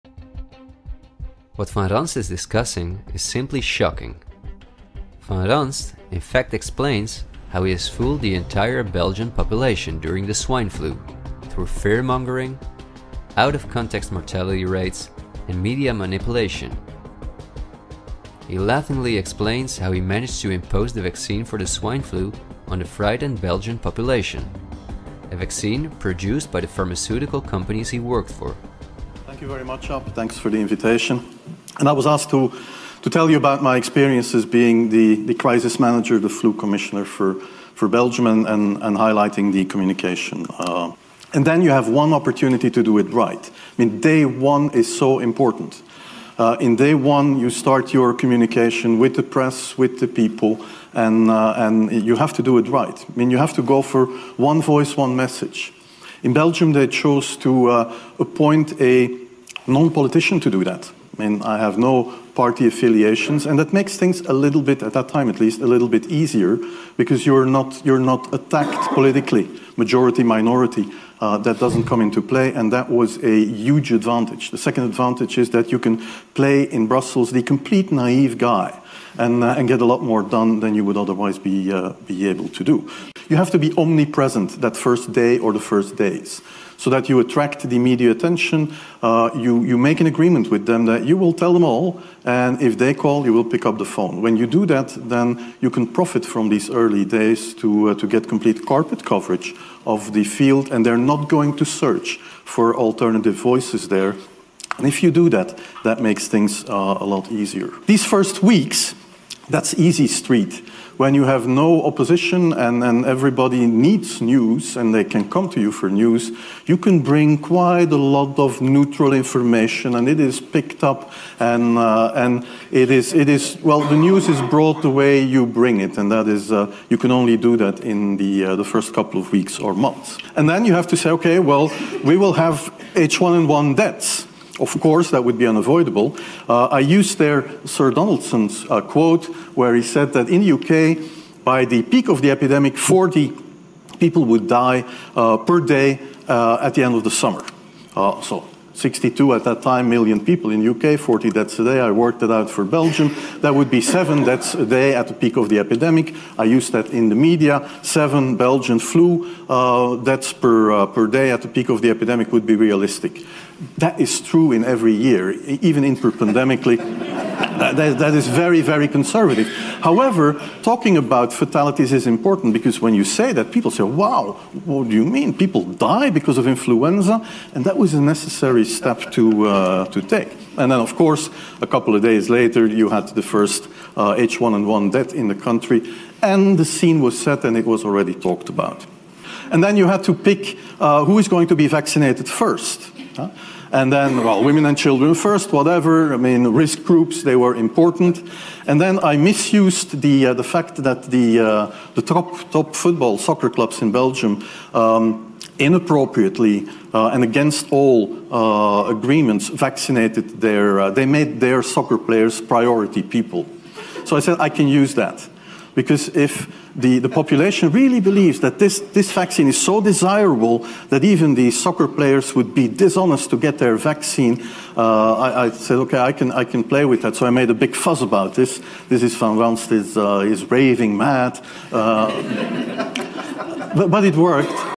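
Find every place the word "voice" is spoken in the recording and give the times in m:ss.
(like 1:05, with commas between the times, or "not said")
0:54, 1:43.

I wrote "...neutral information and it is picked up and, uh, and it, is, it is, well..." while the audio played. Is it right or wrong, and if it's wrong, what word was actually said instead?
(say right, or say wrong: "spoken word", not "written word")
right.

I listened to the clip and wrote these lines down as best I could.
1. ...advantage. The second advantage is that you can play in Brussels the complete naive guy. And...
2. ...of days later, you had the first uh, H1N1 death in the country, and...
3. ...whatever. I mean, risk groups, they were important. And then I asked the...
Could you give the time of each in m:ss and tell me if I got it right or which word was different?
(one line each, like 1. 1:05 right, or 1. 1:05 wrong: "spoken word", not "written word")
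1. 1:13 right
2. 3:01 right
3. 3:15 wrong: "misused", not "asked".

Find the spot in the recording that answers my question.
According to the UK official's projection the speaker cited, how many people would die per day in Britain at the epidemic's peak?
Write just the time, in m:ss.
2:22.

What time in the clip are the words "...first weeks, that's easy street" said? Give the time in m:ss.
1:48.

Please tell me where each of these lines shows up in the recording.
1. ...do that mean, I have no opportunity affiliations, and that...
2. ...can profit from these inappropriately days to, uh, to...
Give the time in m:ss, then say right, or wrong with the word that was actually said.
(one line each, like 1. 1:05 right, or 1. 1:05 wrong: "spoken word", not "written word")
1. 1:00 wrong: "party", not "opportunity"
2. 1:35 wrong: "early", not "inappropriately".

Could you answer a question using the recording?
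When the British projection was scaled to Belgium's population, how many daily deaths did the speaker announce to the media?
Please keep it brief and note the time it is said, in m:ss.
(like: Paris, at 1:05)
7, at 2:33.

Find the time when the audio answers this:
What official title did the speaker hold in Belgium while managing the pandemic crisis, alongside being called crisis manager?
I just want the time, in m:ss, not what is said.
0:36.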